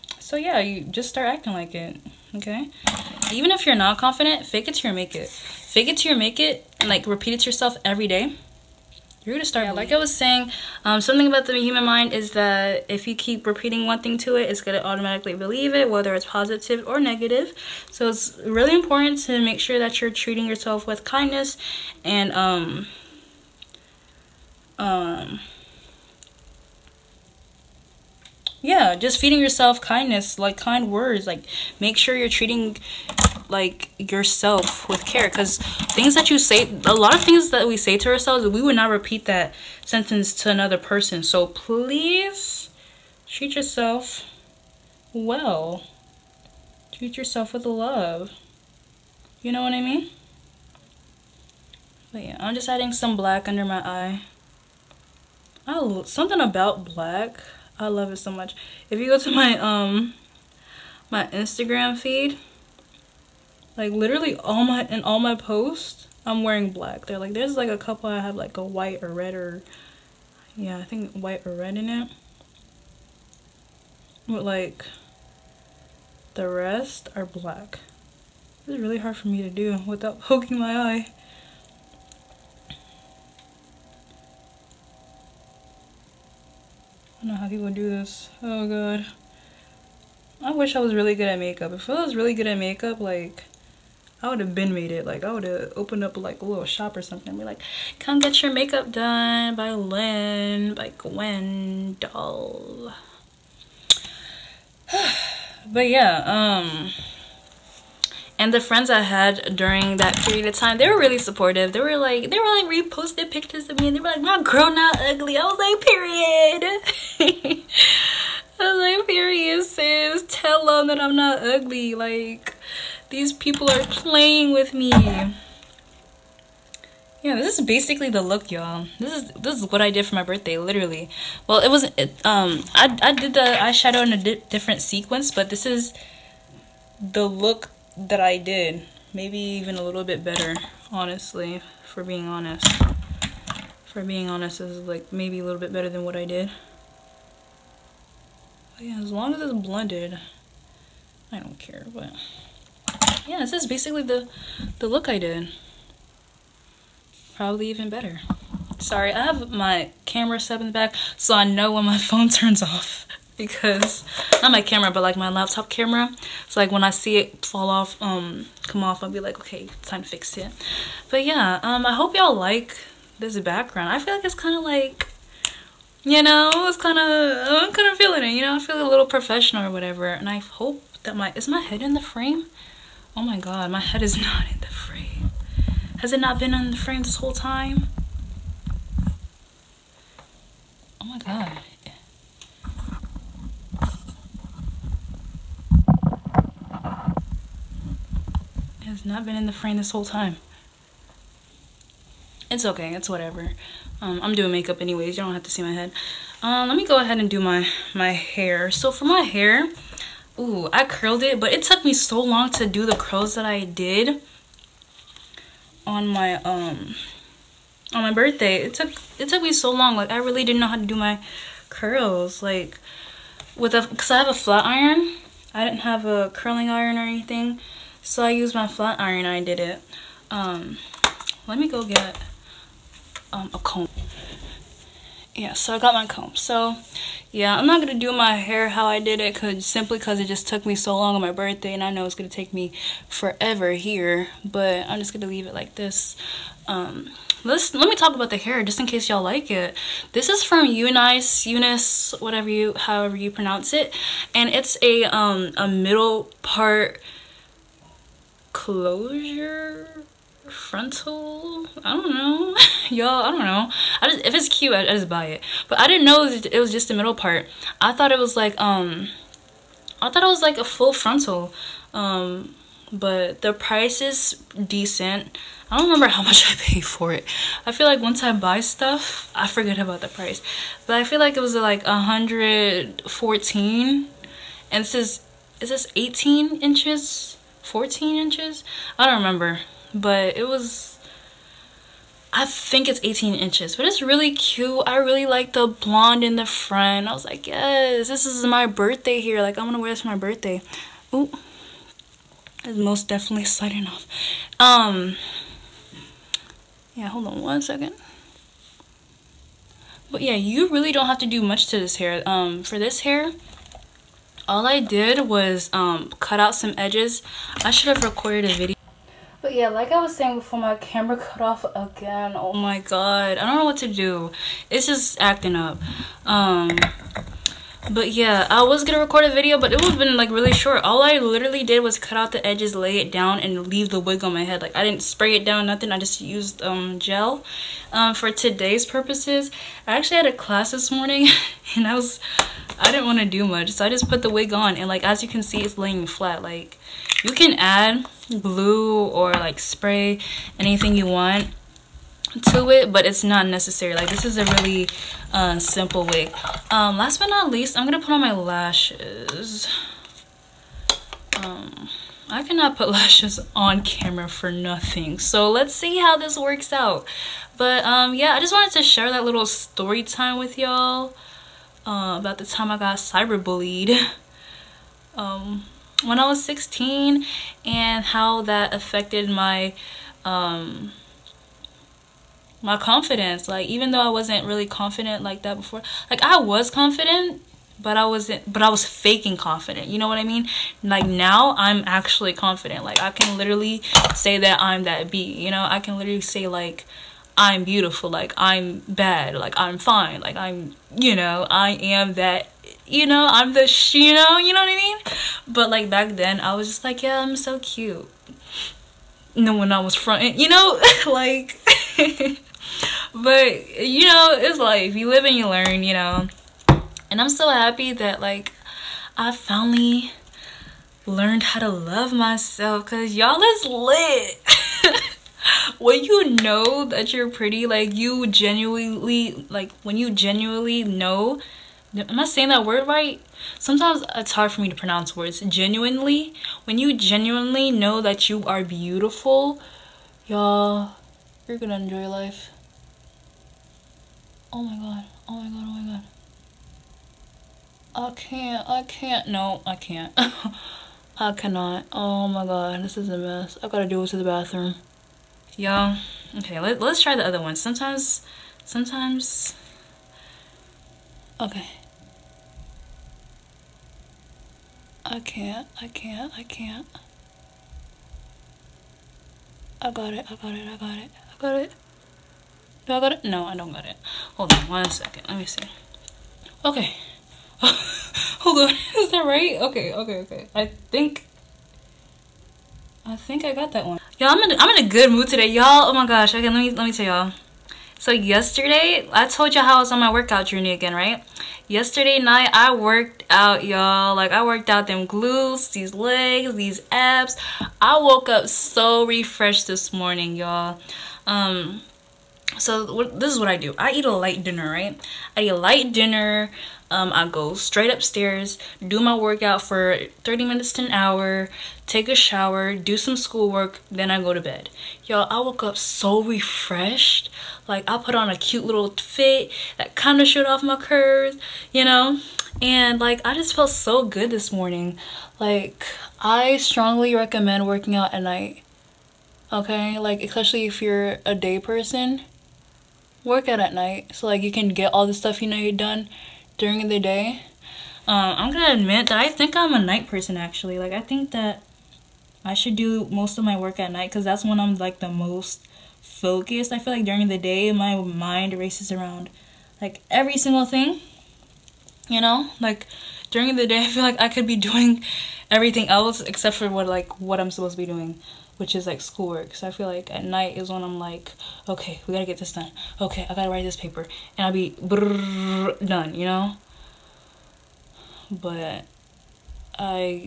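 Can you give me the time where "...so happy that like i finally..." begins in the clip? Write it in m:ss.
6:57.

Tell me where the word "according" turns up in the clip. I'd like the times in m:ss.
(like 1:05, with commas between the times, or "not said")
not said.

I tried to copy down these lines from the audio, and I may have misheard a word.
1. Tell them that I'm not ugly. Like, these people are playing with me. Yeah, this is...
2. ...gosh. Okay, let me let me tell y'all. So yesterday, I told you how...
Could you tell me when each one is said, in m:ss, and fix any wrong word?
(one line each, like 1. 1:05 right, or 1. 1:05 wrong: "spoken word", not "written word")
1. 2:00 right
2. 8:06 right.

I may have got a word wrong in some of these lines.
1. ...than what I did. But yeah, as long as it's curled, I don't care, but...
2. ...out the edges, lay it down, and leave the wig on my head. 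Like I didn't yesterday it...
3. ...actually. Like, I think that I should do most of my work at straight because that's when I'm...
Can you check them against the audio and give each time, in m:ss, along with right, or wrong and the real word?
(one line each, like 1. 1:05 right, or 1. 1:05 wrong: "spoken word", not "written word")
1. 2:25 wrong: "blended", not "curled"
2. 5:32 wrong: "spray", not "yesterday"
3. 9:00 wrong: "night", not "straight".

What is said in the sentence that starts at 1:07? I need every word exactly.
They're like there's like a couple I have like a white or red or yeah, I think white or red in it.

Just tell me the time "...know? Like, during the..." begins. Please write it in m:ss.
9:12.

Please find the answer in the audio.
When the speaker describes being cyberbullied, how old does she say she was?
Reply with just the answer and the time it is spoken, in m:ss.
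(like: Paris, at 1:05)
16, at 6:16.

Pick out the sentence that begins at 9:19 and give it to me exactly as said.
So I feel like at night is when I'm like, okay, we gotta get this done.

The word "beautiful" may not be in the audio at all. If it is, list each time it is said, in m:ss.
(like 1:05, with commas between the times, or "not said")
6:37, 7:18.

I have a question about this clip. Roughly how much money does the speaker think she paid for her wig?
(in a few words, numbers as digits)
114.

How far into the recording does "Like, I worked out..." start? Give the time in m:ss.
8:14.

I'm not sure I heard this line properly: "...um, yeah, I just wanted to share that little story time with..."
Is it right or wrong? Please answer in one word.
right.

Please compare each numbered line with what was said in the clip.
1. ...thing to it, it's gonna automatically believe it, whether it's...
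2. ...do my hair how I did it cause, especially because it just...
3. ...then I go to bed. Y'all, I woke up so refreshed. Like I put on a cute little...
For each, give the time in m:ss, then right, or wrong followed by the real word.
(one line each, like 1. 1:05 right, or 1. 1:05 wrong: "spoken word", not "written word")
1. 0:14 right
2. 3:58 wrong: "simply", not "especially"
3. 8:33 right.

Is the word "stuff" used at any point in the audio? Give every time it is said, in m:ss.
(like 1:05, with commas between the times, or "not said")
4:38, 8:55.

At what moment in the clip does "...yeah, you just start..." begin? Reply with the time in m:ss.
0:00.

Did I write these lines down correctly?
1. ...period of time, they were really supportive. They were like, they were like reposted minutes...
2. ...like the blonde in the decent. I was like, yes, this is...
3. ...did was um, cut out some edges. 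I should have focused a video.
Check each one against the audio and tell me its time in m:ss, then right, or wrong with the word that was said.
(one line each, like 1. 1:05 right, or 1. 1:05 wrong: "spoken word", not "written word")
1. 1:50 wrong: "pictures", not "minutes"
2. 4:55 wrong: "front", not "decent"
3. 5:14 wrong: "recorded", not "focused".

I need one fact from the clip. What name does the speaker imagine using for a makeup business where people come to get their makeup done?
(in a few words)
GwenDoll.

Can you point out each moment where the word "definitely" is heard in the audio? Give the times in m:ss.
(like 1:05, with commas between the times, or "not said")
5:03.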